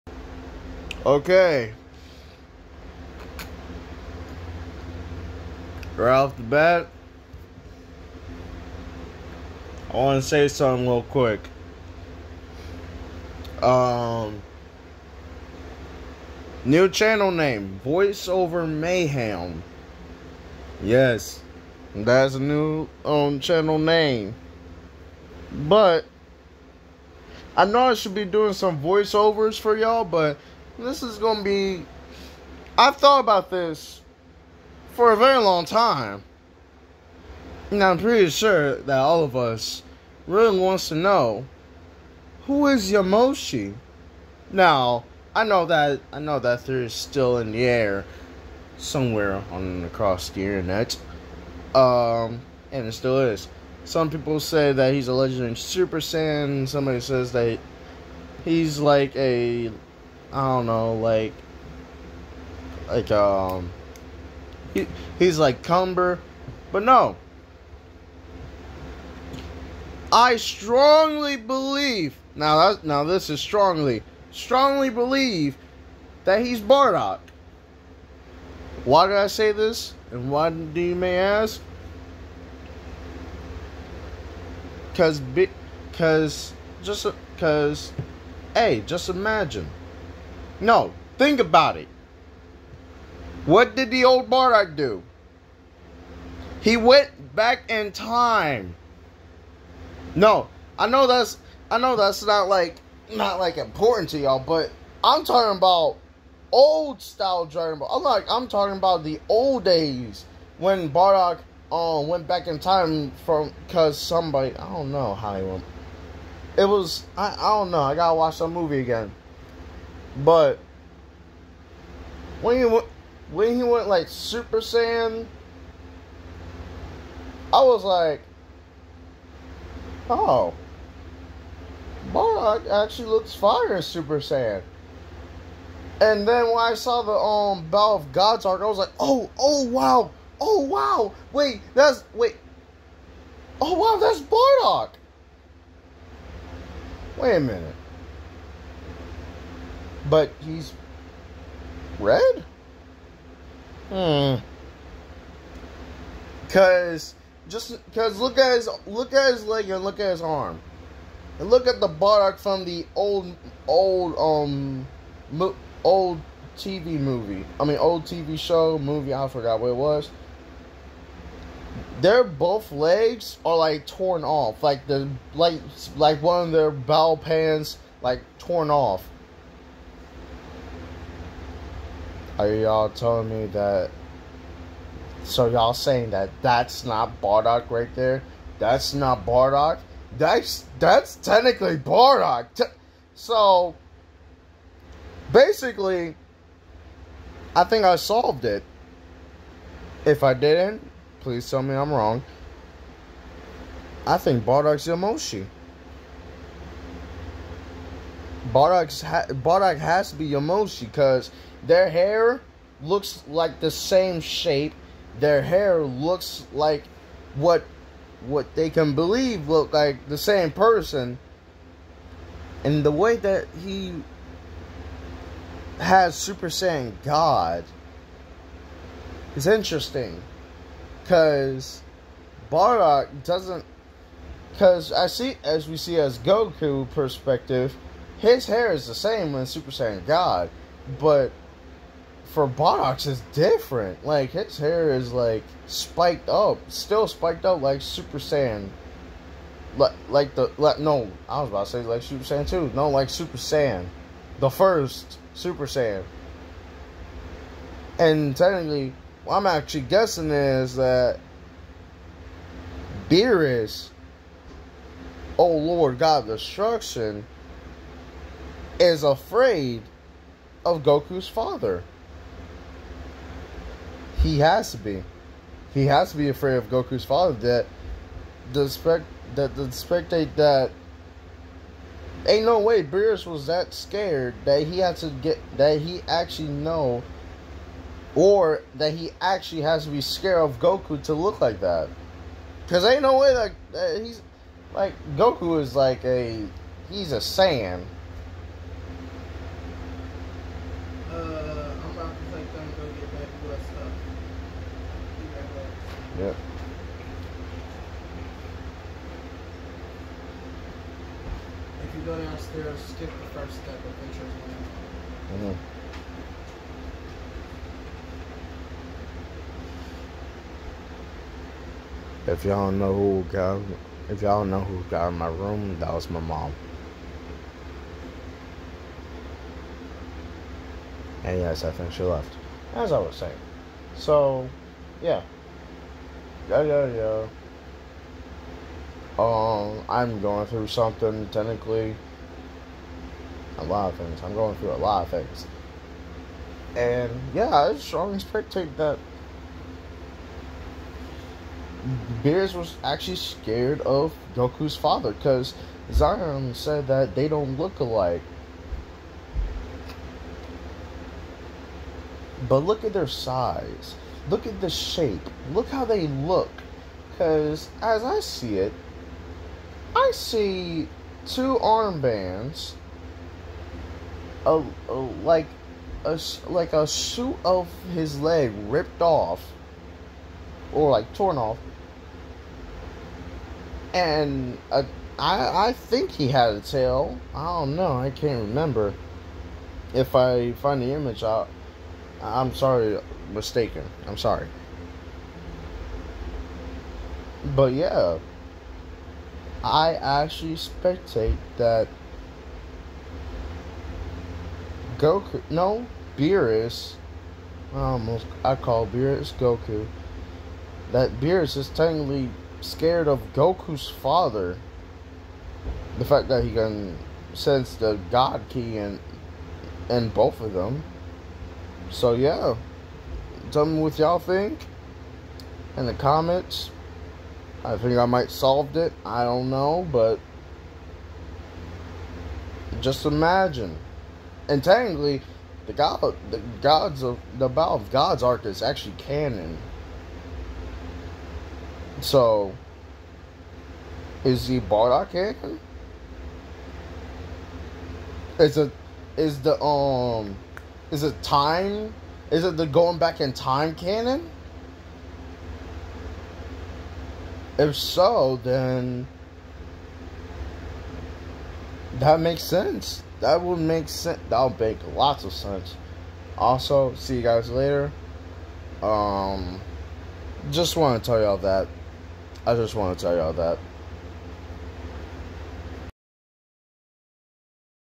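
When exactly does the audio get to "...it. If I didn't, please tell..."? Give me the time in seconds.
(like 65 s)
198 s.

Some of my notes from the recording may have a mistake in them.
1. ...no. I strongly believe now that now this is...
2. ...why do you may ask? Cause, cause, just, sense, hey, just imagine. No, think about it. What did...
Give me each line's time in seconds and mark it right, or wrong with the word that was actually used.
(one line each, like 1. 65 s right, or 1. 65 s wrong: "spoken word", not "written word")
1. 66 s right
2. 80 s wrong: "cause", not "sense".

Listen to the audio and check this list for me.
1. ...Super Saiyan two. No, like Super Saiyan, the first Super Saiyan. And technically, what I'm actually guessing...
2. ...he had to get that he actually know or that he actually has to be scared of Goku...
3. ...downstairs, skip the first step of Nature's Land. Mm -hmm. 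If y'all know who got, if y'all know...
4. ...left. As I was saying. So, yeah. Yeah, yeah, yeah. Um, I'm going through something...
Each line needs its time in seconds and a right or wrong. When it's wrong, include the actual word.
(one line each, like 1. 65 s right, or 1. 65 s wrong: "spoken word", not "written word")
1. 252 s right
2. 284 s right
3. 312 s right
4. 332 s right.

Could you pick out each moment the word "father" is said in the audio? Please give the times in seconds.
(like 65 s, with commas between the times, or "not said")
271 s, 277 s, 354 s, 413 s.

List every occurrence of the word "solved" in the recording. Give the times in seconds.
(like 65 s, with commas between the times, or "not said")
197 s, 428 s.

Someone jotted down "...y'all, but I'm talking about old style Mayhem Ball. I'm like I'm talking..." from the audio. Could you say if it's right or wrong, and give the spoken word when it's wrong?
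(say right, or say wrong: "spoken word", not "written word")
wrong: "Dragon", not "Mayhem".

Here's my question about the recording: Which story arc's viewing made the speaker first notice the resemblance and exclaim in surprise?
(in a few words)
Battle of Gods.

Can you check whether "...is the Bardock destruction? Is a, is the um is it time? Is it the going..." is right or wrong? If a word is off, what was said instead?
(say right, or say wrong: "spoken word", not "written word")
wrong: "canon", not "destruction".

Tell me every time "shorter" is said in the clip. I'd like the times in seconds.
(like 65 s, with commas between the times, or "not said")
not said.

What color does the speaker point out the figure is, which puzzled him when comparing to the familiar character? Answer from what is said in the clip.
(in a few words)
red.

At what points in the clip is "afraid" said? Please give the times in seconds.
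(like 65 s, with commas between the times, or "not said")
269 s, 276 s.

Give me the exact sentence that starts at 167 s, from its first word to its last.
I mean old TV show, movie, I forgot what it was.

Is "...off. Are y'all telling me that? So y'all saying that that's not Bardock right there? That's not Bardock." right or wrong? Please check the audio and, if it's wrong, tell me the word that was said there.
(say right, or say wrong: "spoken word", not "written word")
right.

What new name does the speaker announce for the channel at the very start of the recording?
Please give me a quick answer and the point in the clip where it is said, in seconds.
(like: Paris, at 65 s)
Voiceover Mayhem, at 17 s.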